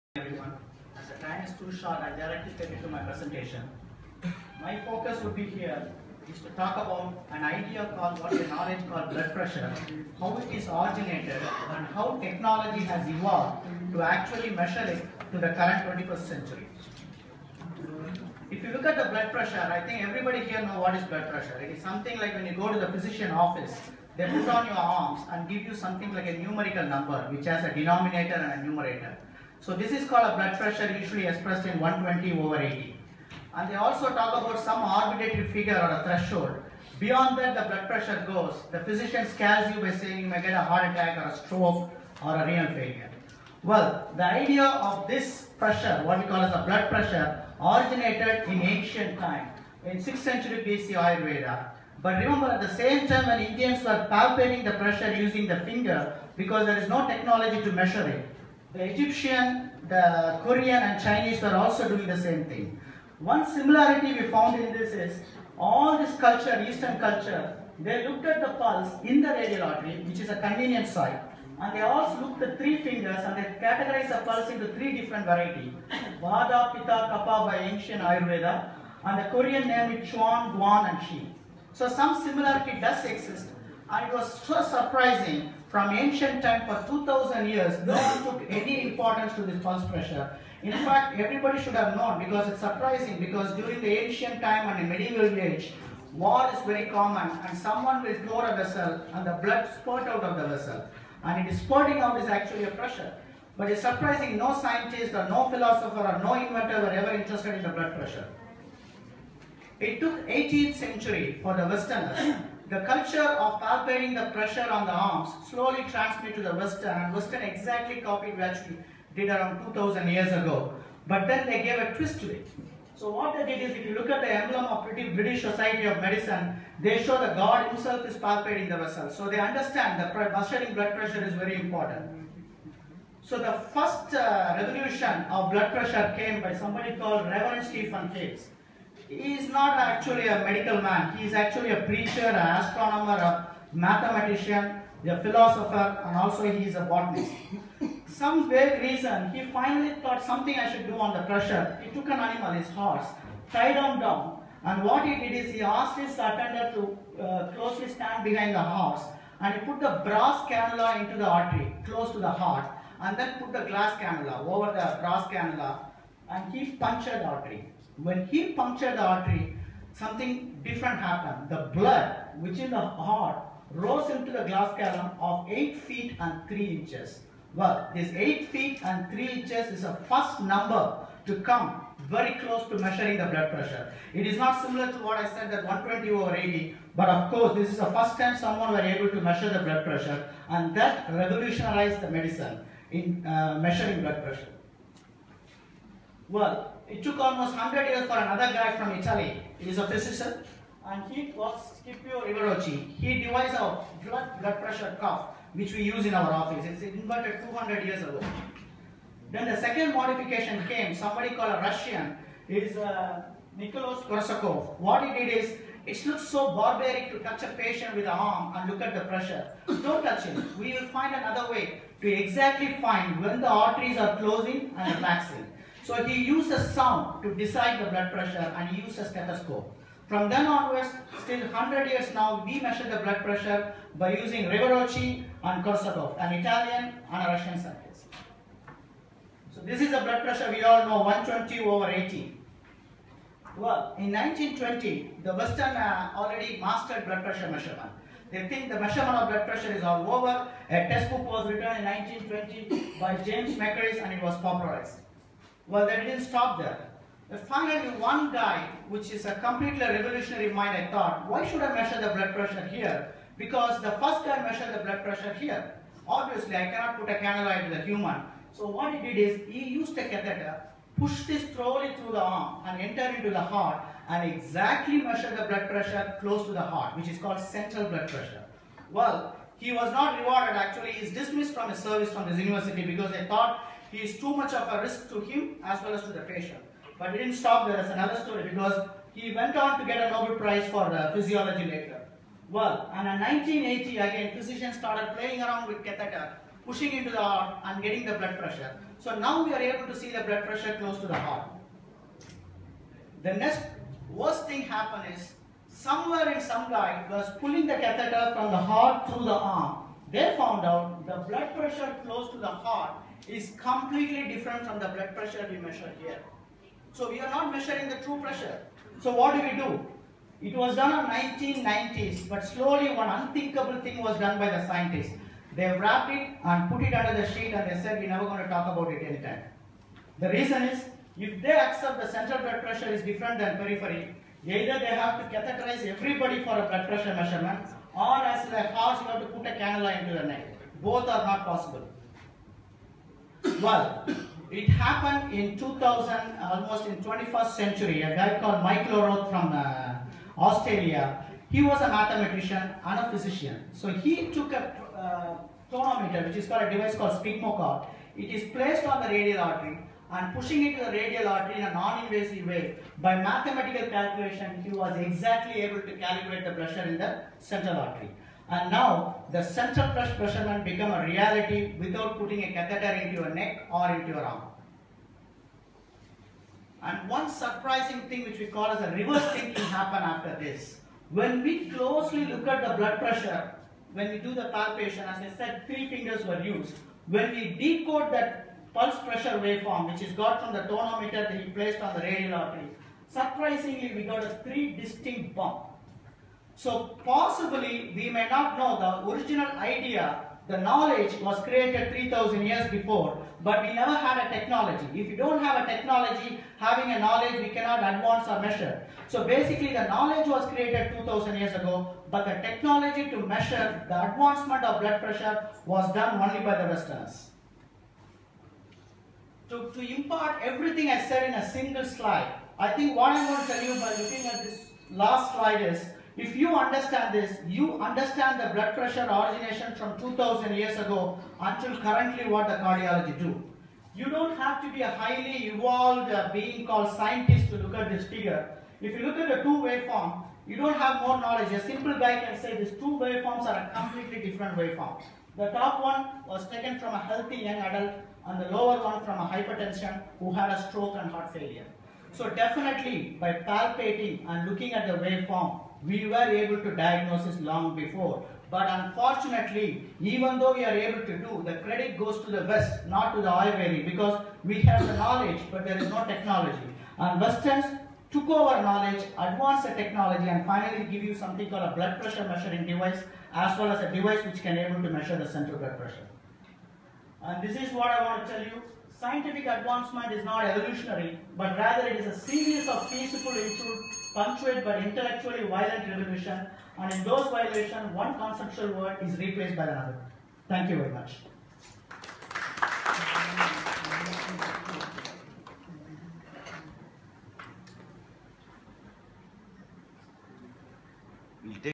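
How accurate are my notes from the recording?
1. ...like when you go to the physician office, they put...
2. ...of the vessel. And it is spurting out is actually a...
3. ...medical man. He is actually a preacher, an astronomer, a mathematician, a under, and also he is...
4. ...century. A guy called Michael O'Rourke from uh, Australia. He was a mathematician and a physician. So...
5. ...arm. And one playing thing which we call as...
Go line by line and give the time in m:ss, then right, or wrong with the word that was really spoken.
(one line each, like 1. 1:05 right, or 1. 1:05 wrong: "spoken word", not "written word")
1. 0:22 right
2. 1:40 right
3. 2:20 wrong: "philosopher", not "under"
4. 5:47 right
5. 6:14 wrong: "surprising", not "playing".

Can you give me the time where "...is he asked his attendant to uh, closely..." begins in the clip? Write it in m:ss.
2:35.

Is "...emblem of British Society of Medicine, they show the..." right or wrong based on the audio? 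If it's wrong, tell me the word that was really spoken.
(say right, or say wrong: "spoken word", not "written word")
right.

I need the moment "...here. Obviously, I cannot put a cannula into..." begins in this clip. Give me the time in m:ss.
4:25.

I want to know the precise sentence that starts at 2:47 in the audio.
When he punctured the artery, something different happened.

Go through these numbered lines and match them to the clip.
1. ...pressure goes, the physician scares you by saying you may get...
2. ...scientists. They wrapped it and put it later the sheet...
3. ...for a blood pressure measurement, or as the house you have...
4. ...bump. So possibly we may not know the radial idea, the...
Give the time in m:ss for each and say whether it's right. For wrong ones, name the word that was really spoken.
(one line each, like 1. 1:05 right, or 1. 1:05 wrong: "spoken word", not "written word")
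1. 0:37 right
2. 5:24 wrong: "under", not "later"
3. 5:36 right
4. 6:35 wrong: "original", not "radial".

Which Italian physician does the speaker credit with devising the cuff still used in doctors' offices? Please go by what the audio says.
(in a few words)
Scipio Rivarocci.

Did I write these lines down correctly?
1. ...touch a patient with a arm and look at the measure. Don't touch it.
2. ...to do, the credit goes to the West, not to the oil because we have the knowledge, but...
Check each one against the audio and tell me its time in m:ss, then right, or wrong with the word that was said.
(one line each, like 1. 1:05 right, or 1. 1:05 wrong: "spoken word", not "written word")
1. 3:37 wrong: "pressure", not "measure"
2. 7:41 right.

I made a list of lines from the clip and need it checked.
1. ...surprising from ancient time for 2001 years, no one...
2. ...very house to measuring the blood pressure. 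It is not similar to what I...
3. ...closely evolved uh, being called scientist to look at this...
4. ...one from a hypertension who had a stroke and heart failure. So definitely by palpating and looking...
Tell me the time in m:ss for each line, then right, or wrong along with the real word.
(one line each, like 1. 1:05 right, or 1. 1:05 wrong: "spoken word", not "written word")
1. 1:24 wrong: "2000", not "2001"
2. 3:02 wrong: "close", not "house"
3. 7:14 wrong: "highly", not "closely"
4. 7:28 right.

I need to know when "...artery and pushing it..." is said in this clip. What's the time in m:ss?
5:59.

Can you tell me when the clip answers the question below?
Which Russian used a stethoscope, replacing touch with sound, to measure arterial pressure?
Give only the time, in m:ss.
3:33.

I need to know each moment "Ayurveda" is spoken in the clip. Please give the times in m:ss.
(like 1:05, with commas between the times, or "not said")
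0:50, 1:18.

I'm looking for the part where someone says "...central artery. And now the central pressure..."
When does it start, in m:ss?
6:07.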